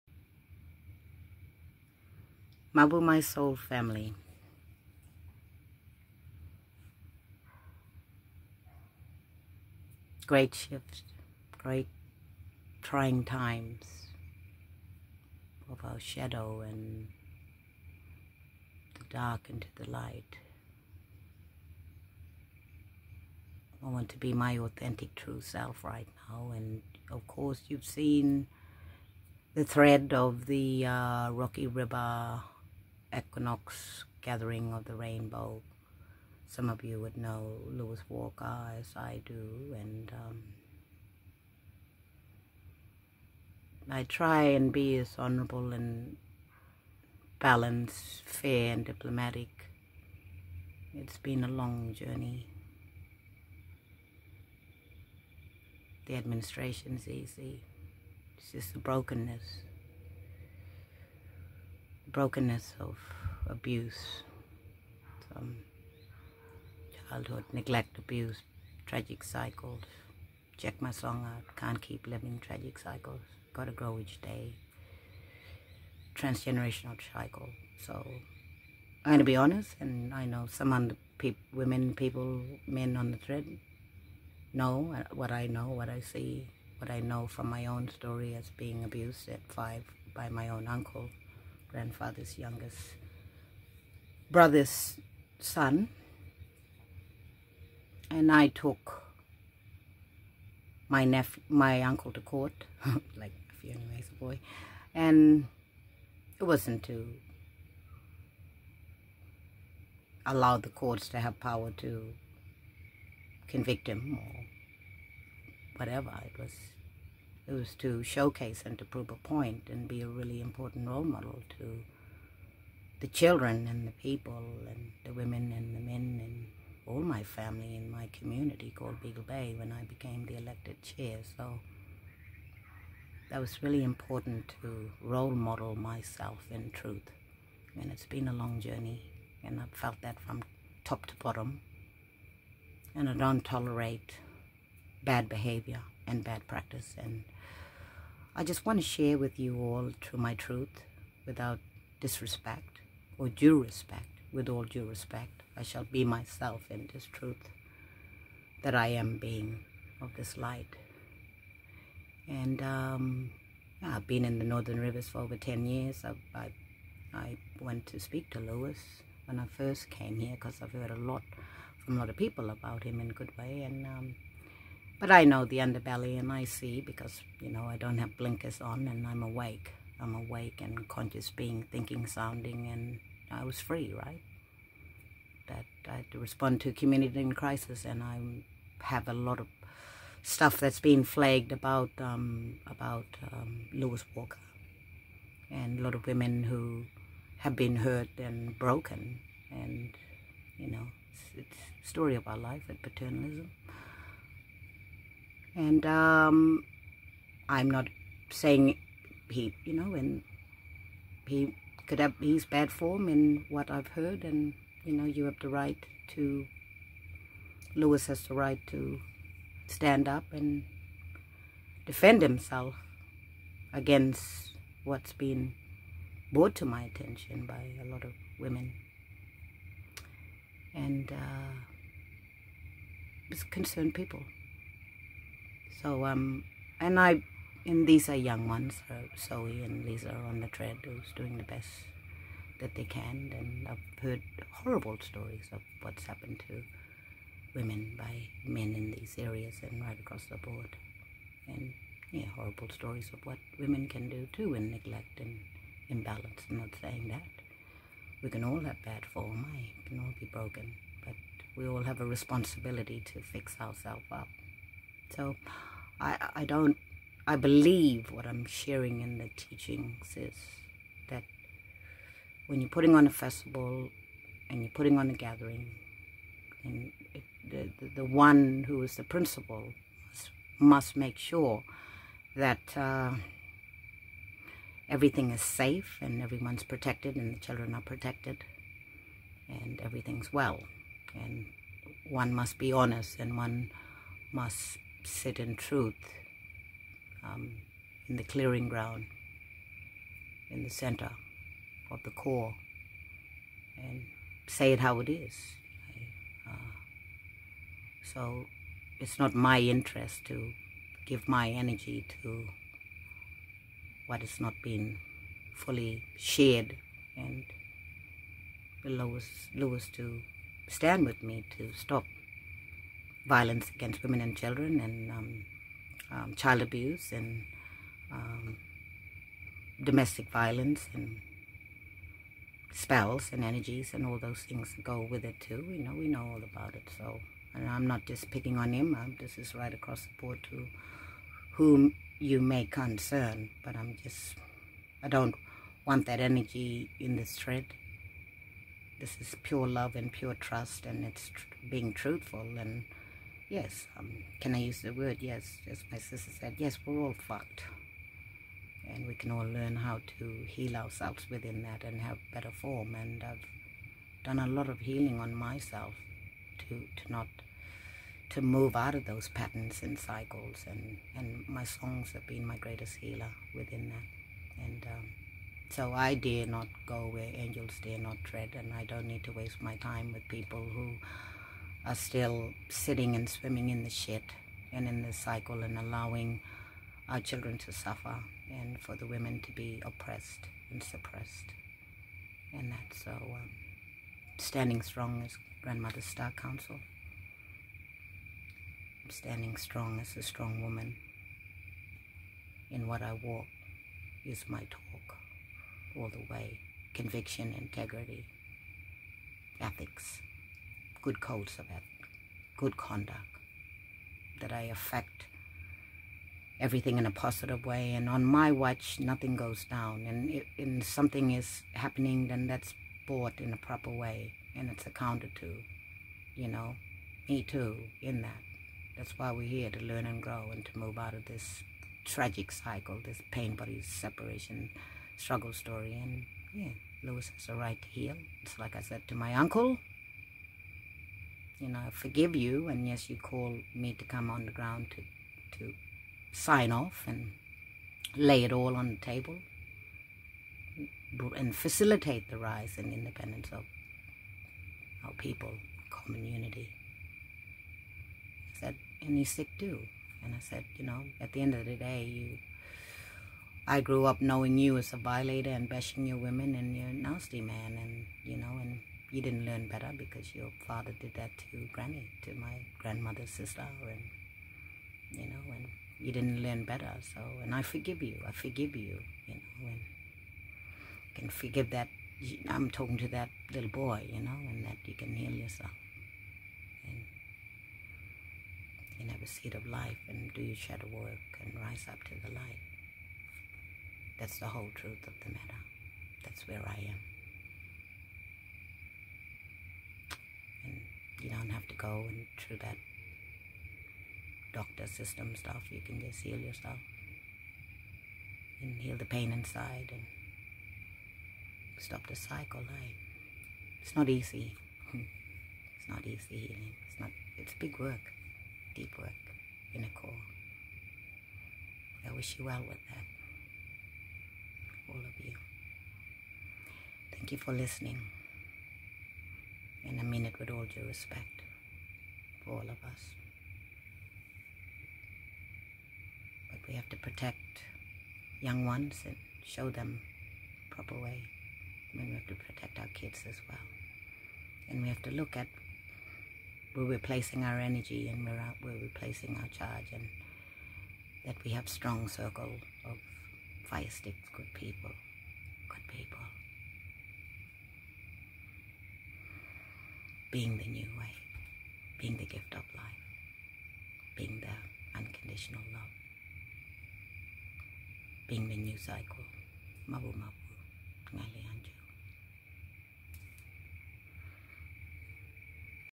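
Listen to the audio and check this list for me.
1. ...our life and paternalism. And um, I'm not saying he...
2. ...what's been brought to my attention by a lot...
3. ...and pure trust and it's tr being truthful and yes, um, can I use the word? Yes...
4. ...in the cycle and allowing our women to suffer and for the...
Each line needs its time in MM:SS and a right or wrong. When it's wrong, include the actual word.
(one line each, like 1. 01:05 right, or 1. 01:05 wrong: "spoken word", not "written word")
1. 03:22 right
2. 03:44 right
3. 05:49 right
4. 06:24 wrong: "children", not "women".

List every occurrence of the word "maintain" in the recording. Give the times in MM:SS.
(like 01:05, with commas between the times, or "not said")
not said.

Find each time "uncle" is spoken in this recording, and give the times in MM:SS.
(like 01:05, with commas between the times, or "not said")
01:30, 01:41, 07:19.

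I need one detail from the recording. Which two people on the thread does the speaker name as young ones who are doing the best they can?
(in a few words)
Zoe and Lisa.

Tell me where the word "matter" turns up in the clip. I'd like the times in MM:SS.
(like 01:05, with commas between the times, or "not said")
08:15.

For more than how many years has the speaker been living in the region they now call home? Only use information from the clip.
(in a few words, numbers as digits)
10.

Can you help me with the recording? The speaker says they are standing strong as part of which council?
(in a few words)
Grandmother Star Council.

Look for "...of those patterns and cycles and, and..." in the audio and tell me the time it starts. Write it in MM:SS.
06:08.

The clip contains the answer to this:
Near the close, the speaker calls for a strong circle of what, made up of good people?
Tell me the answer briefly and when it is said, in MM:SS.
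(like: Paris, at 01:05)
fire sticks, at 09:13.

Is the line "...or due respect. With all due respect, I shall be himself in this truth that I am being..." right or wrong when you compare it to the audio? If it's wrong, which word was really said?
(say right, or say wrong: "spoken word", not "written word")
wrong: "myself", not "himself".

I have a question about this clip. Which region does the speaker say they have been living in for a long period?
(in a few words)
Northern Rivers.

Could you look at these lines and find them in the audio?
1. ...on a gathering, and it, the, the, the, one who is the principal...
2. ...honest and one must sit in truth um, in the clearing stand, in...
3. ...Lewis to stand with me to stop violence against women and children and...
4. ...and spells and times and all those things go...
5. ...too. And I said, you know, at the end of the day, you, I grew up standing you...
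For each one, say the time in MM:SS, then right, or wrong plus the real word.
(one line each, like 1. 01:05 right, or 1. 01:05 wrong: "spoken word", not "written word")
1. 04:34 right
2. 04:52 wrong: "ground", not "stand"
3. 05:18 right
4. 05:30 wrong: "energies", not "times"
5. 07:39 wrong: "knowing", not "standing".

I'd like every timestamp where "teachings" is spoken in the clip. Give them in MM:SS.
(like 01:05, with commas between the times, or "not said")
04:29.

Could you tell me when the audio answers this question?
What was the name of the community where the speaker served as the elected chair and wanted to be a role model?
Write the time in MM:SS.
02:09.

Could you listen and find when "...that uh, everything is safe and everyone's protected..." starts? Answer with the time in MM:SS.
04:42.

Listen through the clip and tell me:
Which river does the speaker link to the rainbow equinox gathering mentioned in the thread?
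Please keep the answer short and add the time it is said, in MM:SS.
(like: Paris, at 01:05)
Rocky River, at 00:31.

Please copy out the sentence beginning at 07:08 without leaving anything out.
That's why we're here to learn and grow and to move out of this tragic cycle, this pain body separation struggle story.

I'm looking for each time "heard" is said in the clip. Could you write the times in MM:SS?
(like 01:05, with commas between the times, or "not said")
02:50, 03:33, 04:04.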